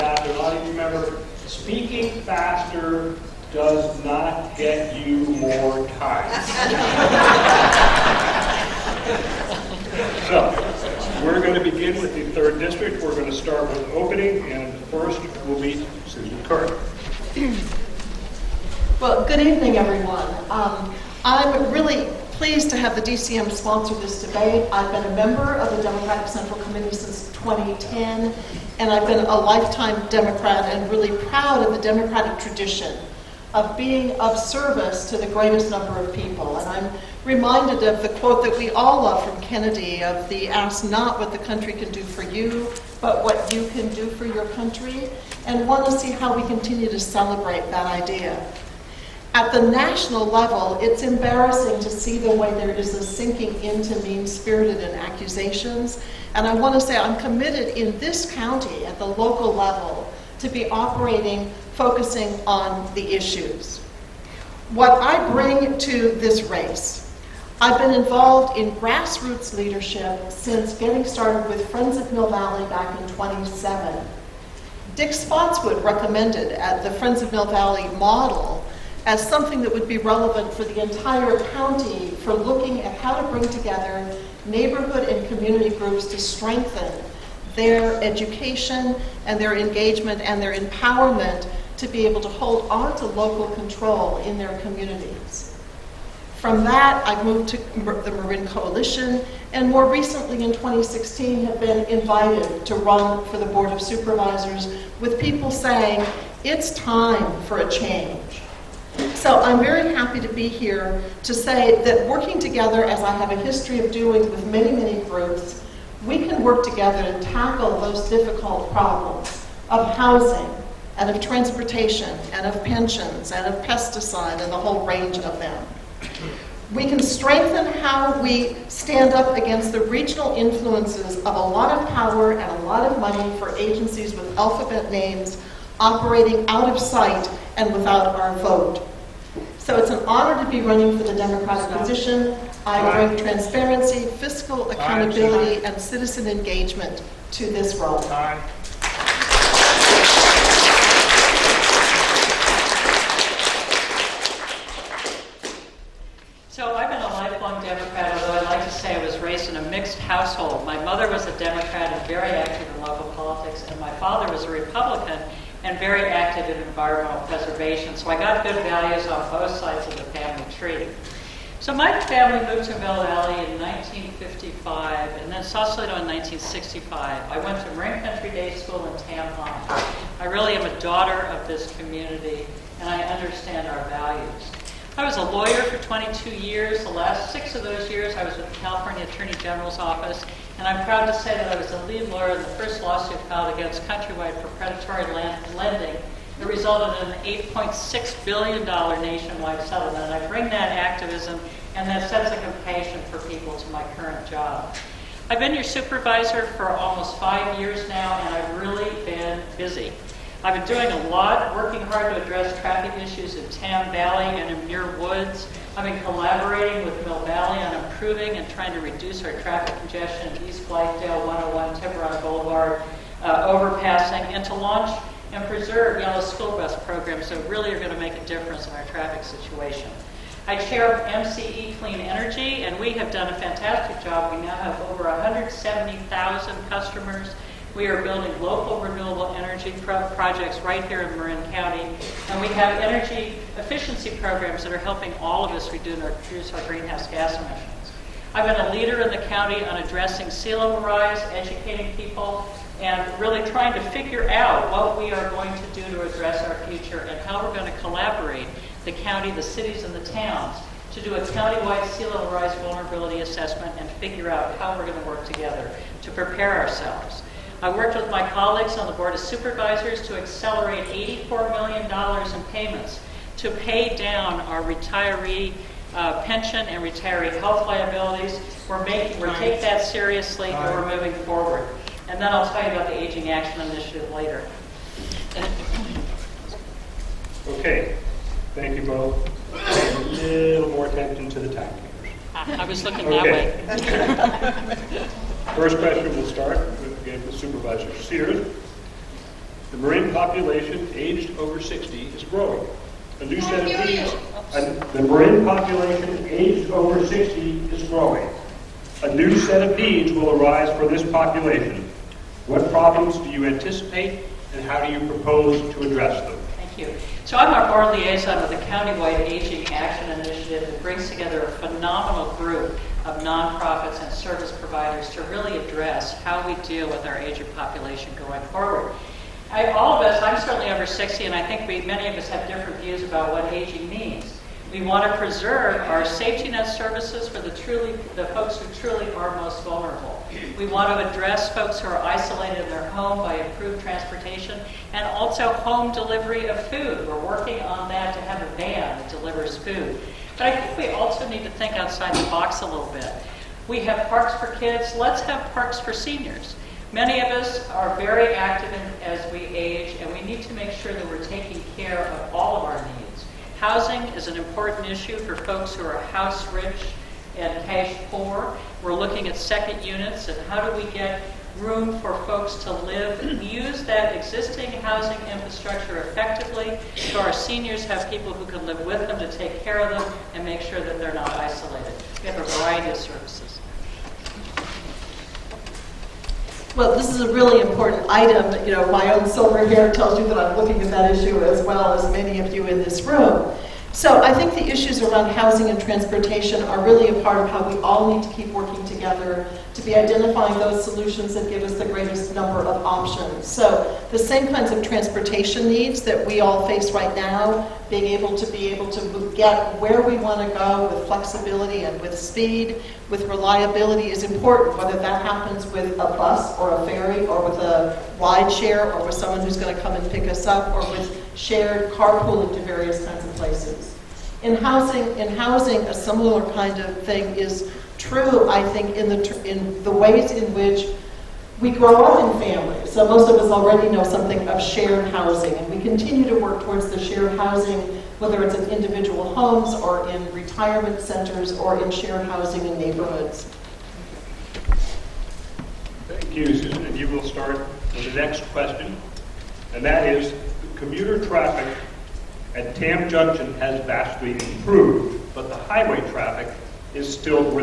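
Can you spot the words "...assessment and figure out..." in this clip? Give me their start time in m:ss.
4:23.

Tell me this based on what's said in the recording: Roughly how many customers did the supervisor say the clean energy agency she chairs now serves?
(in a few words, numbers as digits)
over 170,000.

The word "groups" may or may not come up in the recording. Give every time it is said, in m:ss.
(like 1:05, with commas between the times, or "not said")
1:25, 1:55, 5:22.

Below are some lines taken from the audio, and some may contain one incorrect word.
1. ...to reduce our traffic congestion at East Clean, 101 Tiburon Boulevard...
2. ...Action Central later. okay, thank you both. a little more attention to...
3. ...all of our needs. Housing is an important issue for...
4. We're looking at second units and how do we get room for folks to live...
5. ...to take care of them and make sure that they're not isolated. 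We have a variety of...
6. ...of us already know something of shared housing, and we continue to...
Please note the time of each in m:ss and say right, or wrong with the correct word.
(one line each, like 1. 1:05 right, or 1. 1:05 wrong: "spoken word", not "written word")
1. 3:38 wrong: "Blythedale", not "Clean"
2. 4:43 wrong: "Initiative", not "Central"
3. 6:02 right
4. 6:08 right
5. 6:19 right
6. 7:13 right.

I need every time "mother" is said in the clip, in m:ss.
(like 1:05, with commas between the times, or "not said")
2:40.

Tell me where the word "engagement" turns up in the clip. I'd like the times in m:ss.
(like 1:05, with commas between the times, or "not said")
1:29, 2:26.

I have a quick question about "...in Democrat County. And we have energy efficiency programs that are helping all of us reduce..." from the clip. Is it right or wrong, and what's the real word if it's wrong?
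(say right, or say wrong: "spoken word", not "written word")
wrong: "Marin", not "Democrat".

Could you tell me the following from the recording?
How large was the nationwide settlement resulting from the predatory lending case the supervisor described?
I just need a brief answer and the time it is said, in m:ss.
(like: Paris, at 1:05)
$8.6 billion, at 3:17.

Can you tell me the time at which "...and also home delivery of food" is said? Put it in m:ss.
5:44.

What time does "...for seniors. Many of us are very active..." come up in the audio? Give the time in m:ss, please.
5:55.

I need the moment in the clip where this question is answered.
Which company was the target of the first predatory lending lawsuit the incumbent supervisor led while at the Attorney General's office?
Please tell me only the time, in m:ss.
3:13.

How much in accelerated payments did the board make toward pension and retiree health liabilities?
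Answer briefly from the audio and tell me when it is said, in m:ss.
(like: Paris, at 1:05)
$84 million, at 4:30.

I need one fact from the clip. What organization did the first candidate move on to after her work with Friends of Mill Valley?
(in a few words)
Marin Coalition.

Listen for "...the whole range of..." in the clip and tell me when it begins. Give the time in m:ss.
2:04.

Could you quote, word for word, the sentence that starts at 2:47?
So I got good values on both sides of the family tree.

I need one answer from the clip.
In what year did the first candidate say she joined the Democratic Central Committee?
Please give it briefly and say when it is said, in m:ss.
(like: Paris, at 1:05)
2010, at 0:27.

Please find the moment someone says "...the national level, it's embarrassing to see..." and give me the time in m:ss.
0:49.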